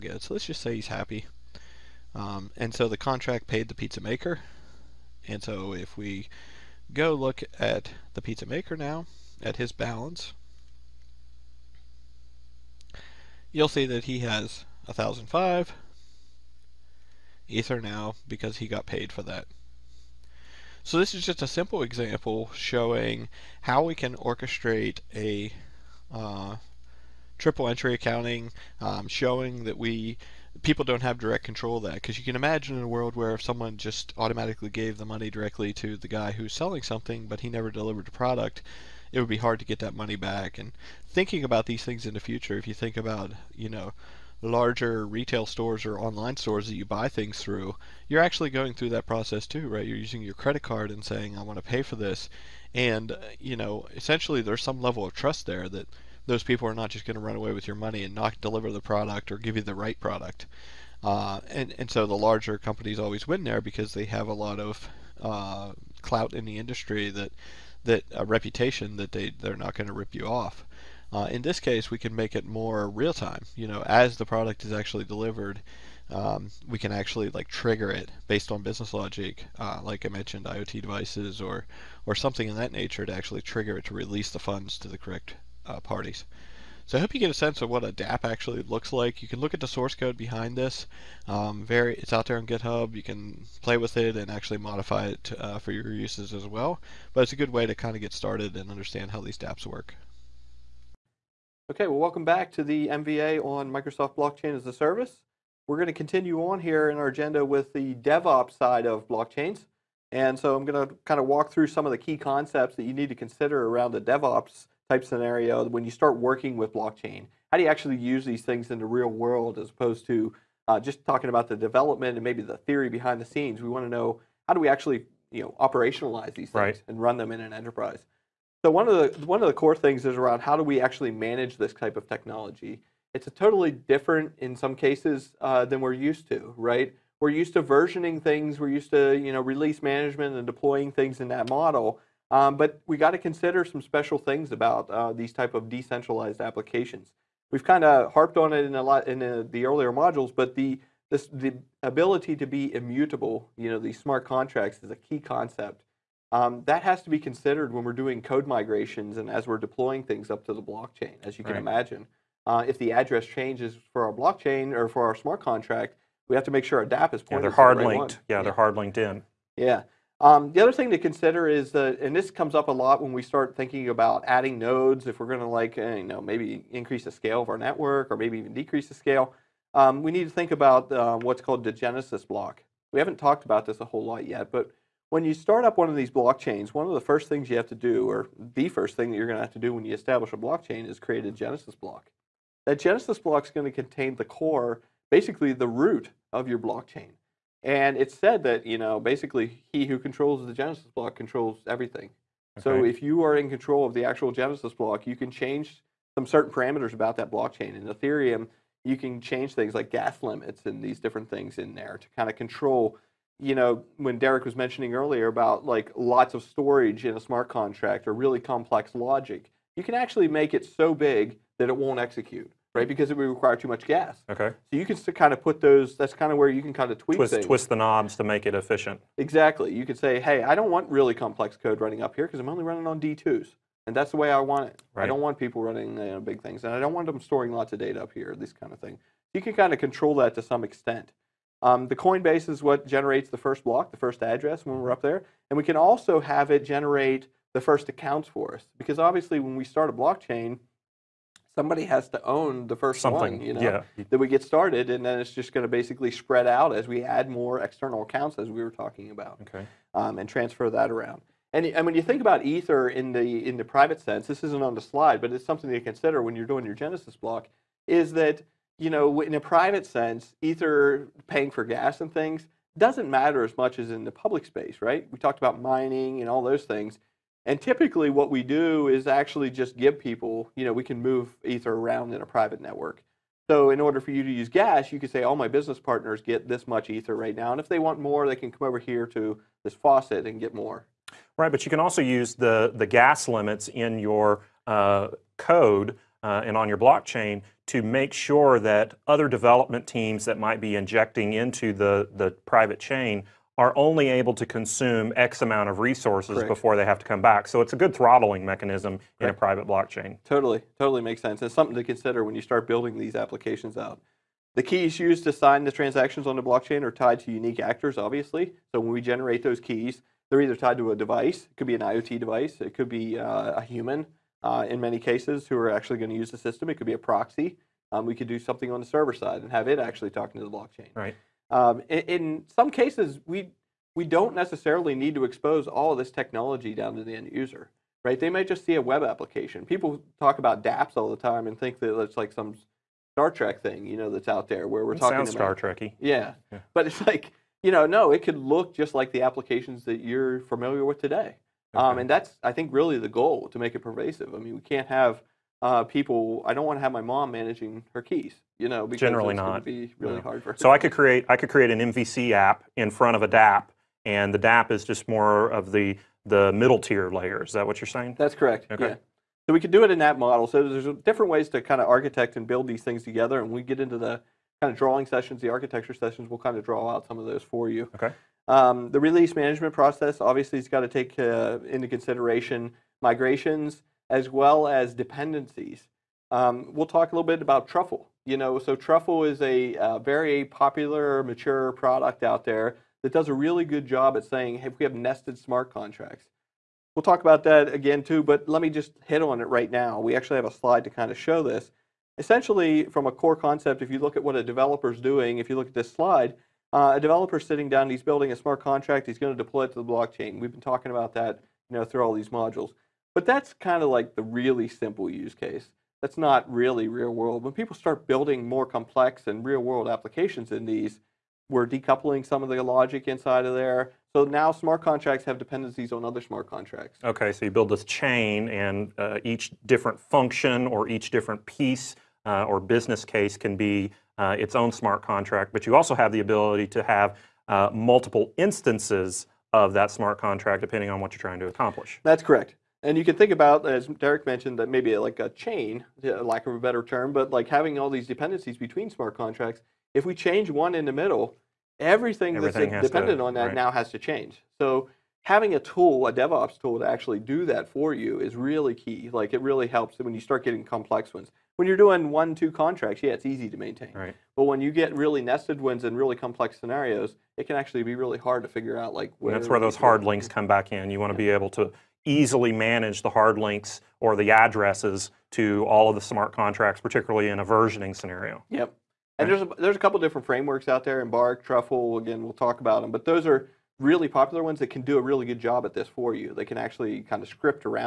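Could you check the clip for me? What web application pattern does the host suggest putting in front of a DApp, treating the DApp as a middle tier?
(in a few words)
MVC app.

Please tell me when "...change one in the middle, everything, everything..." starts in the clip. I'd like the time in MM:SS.
07:30.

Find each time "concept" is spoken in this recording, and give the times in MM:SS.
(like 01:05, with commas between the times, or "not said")
01:52, 02:35, 06:43.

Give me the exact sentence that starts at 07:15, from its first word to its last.
But you also have the ability to have uh, multiple instances of that smart contract depending on what you're trying to accomplish.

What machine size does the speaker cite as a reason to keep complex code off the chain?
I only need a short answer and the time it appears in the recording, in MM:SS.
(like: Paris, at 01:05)
D2s, at 03:53.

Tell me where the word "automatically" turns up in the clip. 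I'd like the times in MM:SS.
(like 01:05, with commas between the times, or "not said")
00:34.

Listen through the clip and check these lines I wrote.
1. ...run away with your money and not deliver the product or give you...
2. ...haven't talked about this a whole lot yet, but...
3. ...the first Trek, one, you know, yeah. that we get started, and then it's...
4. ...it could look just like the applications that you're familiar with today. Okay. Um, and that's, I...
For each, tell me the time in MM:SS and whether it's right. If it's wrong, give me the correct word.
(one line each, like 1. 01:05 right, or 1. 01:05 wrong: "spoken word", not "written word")
1. 00:57 right
2. 03:02 right
3. 04:12 wrong: "Something", not "Trek"
4. 05:48 right.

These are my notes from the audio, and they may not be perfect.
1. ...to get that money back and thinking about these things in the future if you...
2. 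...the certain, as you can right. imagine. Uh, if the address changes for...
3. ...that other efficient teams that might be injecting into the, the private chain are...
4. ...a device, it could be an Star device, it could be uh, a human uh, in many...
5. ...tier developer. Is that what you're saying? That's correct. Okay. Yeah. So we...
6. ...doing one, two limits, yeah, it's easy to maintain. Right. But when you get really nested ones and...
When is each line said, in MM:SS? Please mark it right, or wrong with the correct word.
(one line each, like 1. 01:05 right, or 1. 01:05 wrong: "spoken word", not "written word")
1. 00:39 right
2. 02:40 wrong: "blockchain", not "certain"
3. 04:58 wrong: "development", not "efficient"
4. 05:20 wrong: "IoT", not "Star"
5. 06:06 wrong: "layer", not "developer"
6. 07:41 wrong: "contracts", not "limits".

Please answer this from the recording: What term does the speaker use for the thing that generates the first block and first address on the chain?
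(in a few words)
Coinbase.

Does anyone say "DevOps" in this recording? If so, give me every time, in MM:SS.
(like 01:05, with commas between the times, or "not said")
01:47, 01:54, 07:36.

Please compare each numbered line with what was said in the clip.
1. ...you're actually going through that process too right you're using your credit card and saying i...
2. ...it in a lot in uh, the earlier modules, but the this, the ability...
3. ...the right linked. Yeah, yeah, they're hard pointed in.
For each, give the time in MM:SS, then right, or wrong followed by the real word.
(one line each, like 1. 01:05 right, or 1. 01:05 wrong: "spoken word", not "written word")
1. 00:48 right
2. 02:28 right
3. 02:47 wrong: "linked", not "pointed".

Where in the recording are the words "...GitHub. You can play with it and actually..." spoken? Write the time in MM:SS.
01:32.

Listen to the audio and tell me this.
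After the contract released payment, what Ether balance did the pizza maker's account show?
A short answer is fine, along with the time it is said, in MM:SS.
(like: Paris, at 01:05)
1005 Ether, at 00:14.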